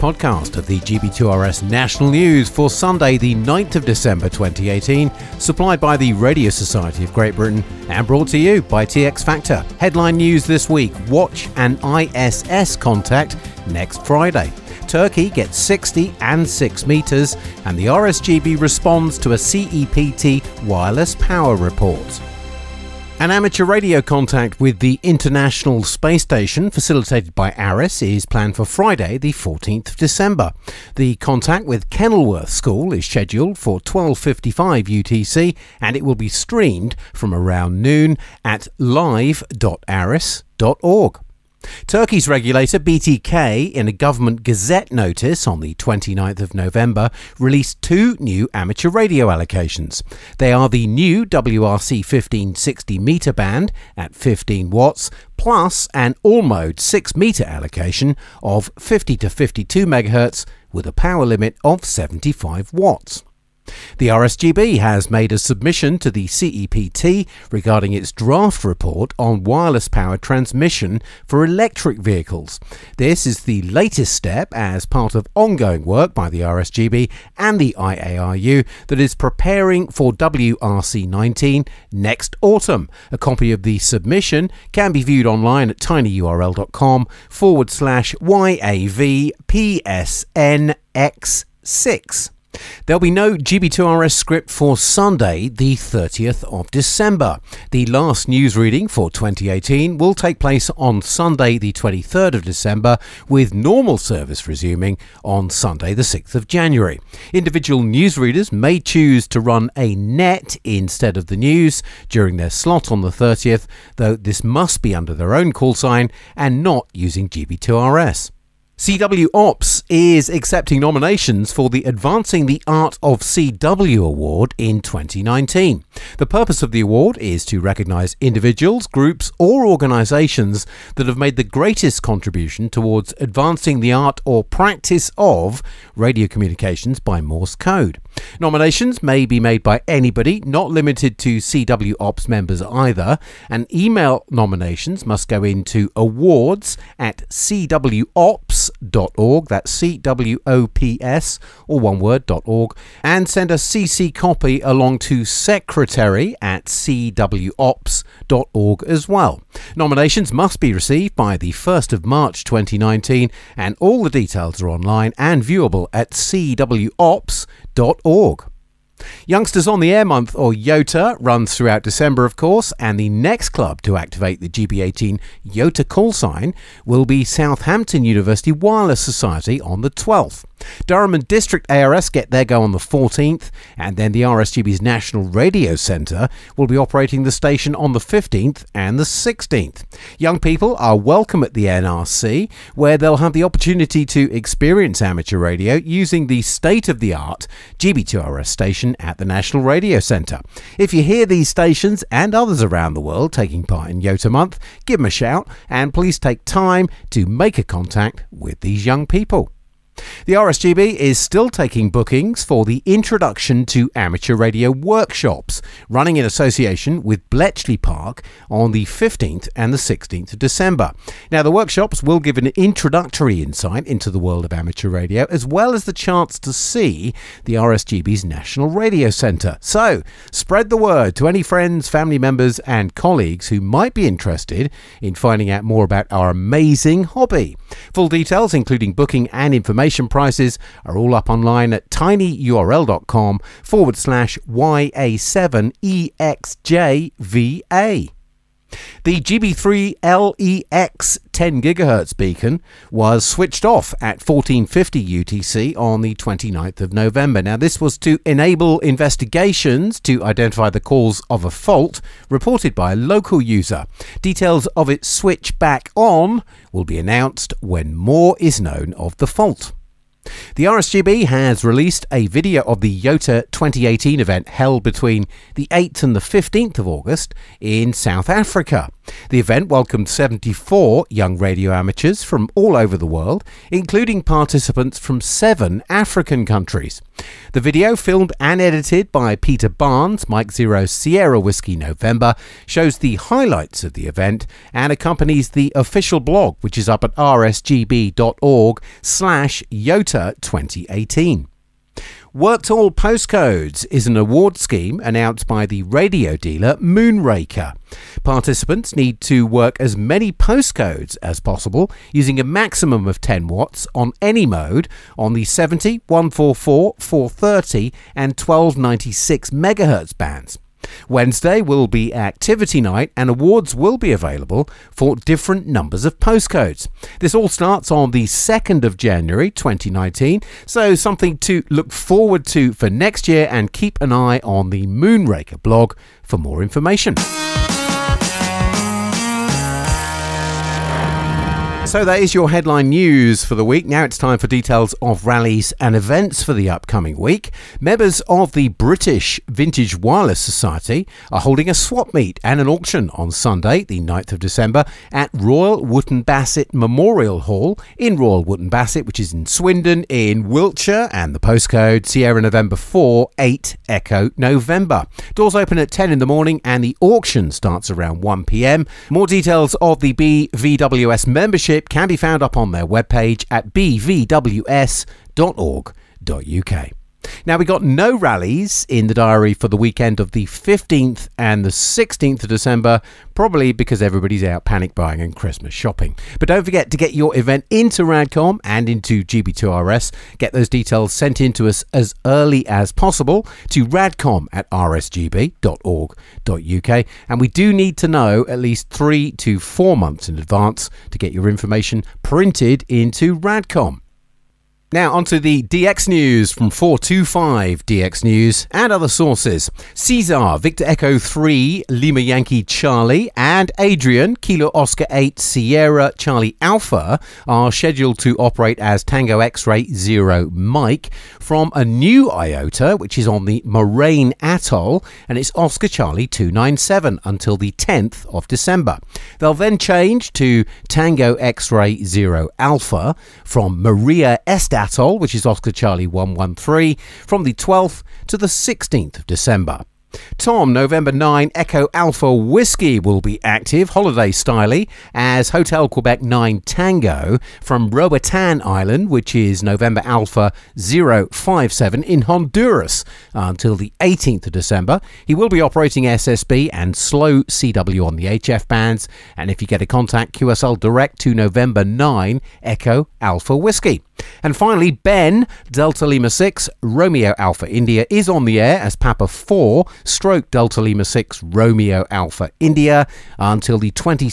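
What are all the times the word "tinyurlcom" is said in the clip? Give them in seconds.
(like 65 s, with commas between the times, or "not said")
85 s, 241 s.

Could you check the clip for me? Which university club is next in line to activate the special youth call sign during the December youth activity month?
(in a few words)
Southampton University Wireless Society.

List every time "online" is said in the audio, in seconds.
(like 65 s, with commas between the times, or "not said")
85 s, 164 s, 241 s.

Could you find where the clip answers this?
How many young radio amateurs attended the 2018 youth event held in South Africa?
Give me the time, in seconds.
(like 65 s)
280 s.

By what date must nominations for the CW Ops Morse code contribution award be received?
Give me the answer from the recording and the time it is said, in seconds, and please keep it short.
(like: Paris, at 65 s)
1st of March 2019, at 161 s.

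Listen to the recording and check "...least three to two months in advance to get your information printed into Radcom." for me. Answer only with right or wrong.
wrong.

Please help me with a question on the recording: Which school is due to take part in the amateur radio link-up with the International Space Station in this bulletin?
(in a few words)
Kenilworth School.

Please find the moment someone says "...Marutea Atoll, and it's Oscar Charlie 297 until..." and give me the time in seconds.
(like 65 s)
423 s.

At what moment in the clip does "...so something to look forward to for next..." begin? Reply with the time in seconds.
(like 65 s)
330 s.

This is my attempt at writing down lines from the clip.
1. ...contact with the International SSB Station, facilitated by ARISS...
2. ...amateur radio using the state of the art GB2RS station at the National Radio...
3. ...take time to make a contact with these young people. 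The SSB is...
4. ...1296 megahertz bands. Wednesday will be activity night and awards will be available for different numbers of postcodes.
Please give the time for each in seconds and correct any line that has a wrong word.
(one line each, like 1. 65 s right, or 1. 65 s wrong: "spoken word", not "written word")
1. 24 s wrong: "Space", not "SSB"
2. 195 s right
3. 206 s wrong: "RSGB", not "SSB"
4. 318 s right.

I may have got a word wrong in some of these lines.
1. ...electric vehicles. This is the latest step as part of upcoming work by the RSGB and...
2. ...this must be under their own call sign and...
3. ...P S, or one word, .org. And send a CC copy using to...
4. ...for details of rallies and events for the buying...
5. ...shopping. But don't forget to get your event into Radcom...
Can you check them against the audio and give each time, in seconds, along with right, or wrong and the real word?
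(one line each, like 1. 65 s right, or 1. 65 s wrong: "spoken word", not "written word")
1. 71 s wrong: "ongoing", not "upcoming"
2. 114 s right
3. 150 s wrong: "along", not "using"
4. 344 s wrong: "upcoming", not "buying"
5. 385 s right.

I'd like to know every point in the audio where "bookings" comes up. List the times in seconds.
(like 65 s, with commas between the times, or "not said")
211 s, 238 s.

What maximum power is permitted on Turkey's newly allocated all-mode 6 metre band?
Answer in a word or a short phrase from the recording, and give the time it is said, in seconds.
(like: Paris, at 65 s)
75 watts, at 61 s.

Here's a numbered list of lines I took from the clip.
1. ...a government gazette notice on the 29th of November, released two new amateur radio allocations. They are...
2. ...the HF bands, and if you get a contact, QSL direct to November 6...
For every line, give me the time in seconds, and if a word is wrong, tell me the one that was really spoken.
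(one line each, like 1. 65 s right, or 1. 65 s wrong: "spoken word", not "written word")
1. 43 s right
2. 458 s wrong: "9", not "6".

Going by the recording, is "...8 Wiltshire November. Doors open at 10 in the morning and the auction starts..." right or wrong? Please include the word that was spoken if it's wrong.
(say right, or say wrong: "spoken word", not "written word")
wrong: "Echo", not "Wiltshire".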